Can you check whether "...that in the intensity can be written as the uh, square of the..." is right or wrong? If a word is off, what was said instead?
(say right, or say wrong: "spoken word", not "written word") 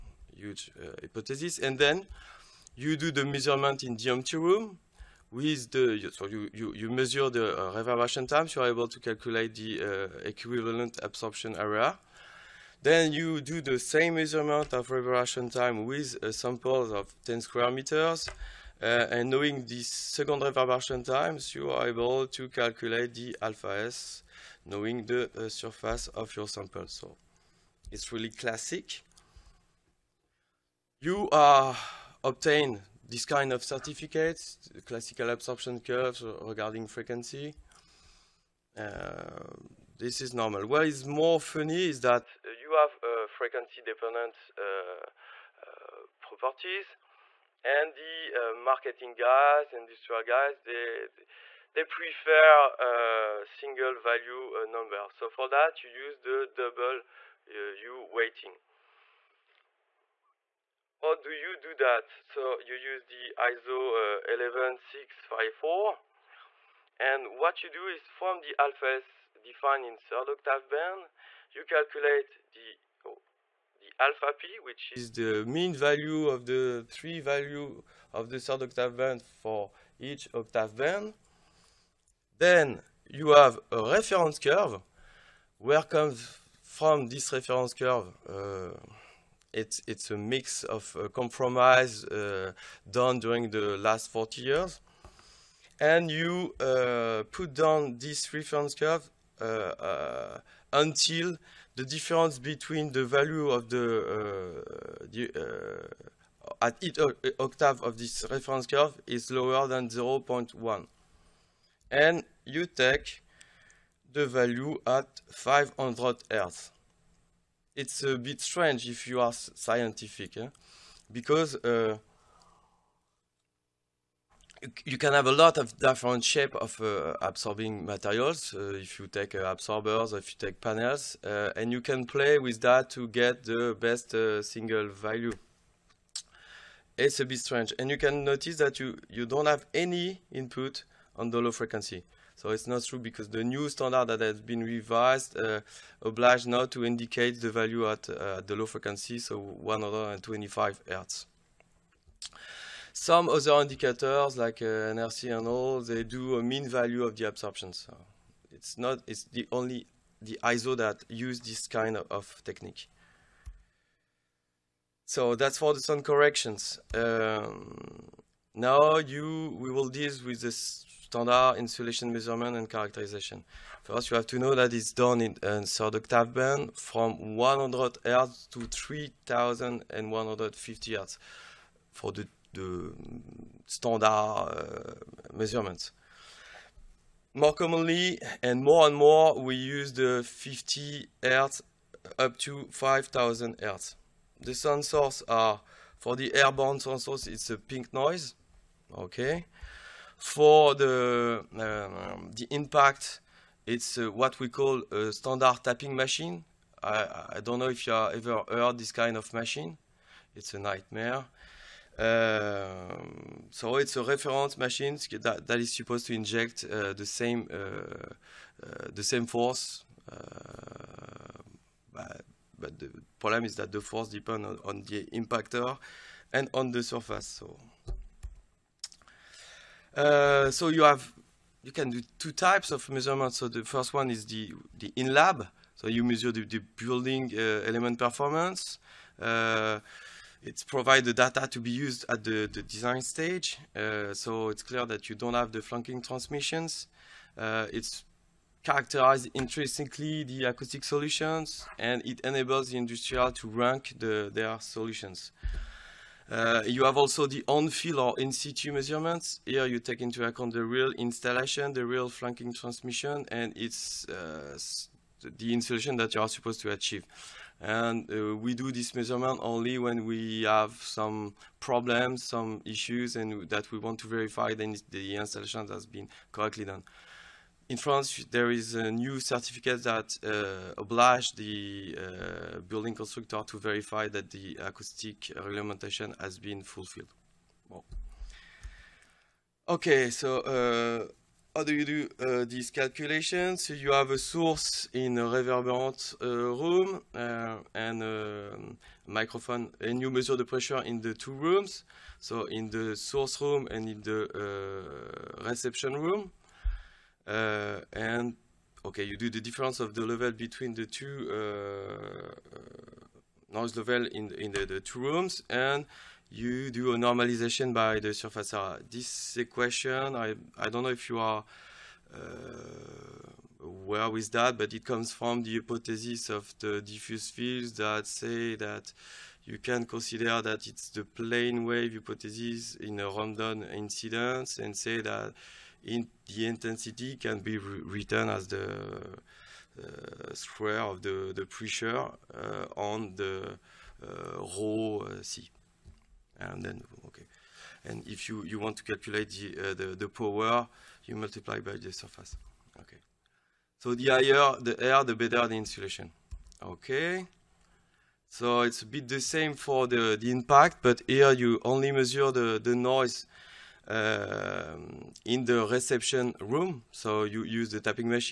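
right.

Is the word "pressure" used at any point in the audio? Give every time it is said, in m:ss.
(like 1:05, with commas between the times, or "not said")
5:00, 5:41.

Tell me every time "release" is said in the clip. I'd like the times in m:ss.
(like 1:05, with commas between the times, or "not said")
not said.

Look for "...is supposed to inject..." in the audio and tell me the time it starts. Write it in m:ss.
3:35.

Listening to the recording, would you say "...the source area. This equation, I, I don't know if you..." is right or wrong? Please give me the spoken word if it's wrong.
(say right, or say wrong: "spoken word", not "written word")
wrong: "surface", not "source".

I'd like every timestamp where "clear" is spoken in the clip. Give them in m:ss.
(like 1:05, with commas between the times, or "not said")
4:04.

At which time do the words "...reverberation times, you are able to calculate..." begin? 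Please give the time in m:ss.
0:20.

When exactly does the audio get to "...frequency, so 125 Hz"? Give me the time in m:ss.
2:28.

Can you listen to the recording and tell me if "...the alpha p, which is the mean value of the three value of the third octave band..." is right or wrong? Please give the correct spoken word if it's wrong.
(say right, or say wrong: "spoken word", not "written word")
right.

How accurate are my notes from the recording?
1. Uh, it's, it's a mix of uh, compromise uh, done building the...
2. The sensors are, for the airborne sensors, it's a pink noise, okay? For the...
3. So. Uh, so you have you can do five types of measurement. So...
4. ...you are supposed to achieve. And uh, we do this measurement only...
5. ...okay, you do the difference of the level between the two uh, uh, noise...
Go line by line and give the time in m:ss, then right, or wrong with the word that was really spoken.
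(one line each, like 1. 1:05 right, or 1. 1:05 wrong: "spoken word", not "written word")
1. 1:28 wrong: "during", not "building"
2. 3:14 right
3. 3:47 wrong: "two", not "five"
4. 4:26 right
5. 5:08 right.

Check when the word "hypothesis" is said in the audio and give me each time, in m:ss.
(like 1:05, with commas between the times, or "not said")
0:01, 5:25, 5:31.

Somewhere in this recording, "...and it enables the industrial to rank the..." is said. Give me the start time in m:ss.
4:11.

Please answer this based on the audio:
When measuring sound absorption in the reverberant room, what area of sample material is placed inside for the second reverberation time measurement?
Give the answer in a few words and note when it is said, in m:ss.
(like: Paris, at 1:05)
10 square meters, at 0:17.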